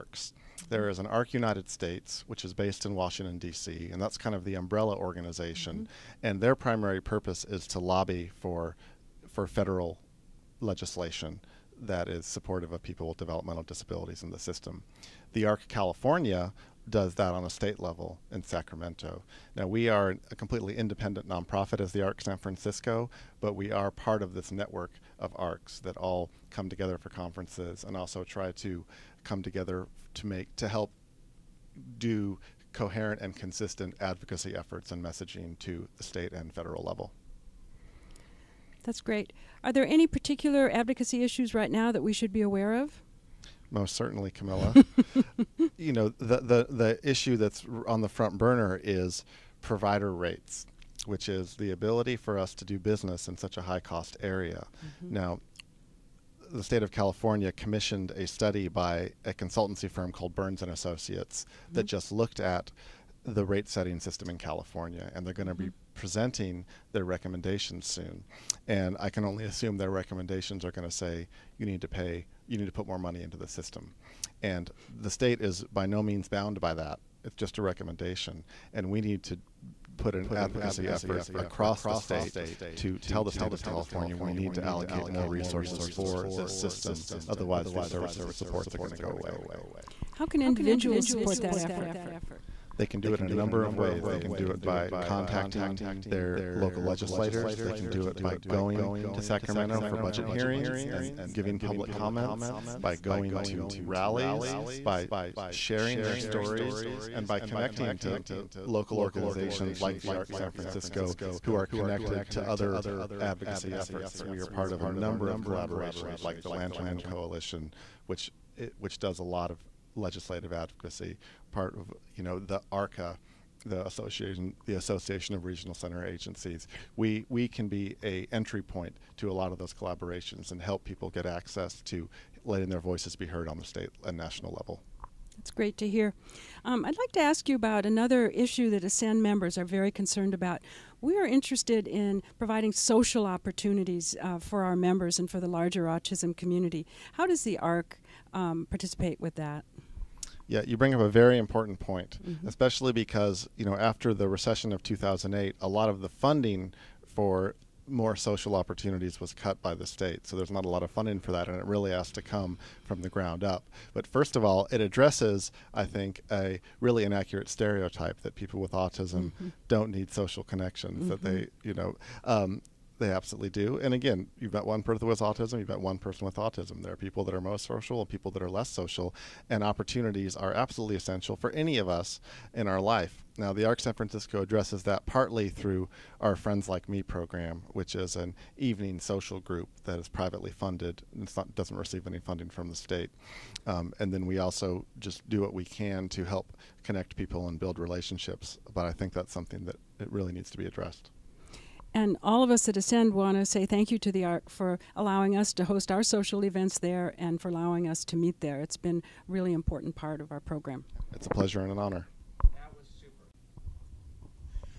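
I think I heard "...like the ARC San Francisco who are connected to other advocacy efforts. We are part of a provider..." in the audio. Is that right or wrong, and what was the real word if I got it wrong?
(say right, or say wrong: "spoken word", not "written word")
wrong: "number", not "provider".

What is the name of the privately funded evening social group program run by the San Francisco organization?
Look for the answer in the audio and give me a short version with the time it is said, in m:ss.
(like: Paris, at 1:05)
Friends Like Me, at 3:06.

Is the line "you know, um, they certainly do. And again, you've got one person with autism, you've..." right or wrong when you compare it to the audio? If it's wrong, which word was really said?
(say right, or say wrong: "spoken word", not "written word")
wrong: "absolutely", not "certainly".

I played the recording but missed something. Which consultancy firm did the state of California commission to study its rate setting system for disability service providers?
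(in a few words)
Burns and Associates.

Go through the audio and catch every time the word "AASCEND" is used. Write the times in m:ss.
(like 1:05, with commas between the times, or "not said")
2:18, 3:22.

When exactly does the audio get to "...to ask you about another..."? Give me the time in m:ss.
2:17.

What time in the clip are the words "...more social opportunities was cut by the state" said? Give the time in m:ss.
2:37.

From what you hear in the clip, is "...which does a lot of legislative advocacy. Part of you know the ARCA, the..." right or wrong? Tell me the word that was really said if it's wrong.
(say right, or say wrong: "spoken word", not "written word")
right.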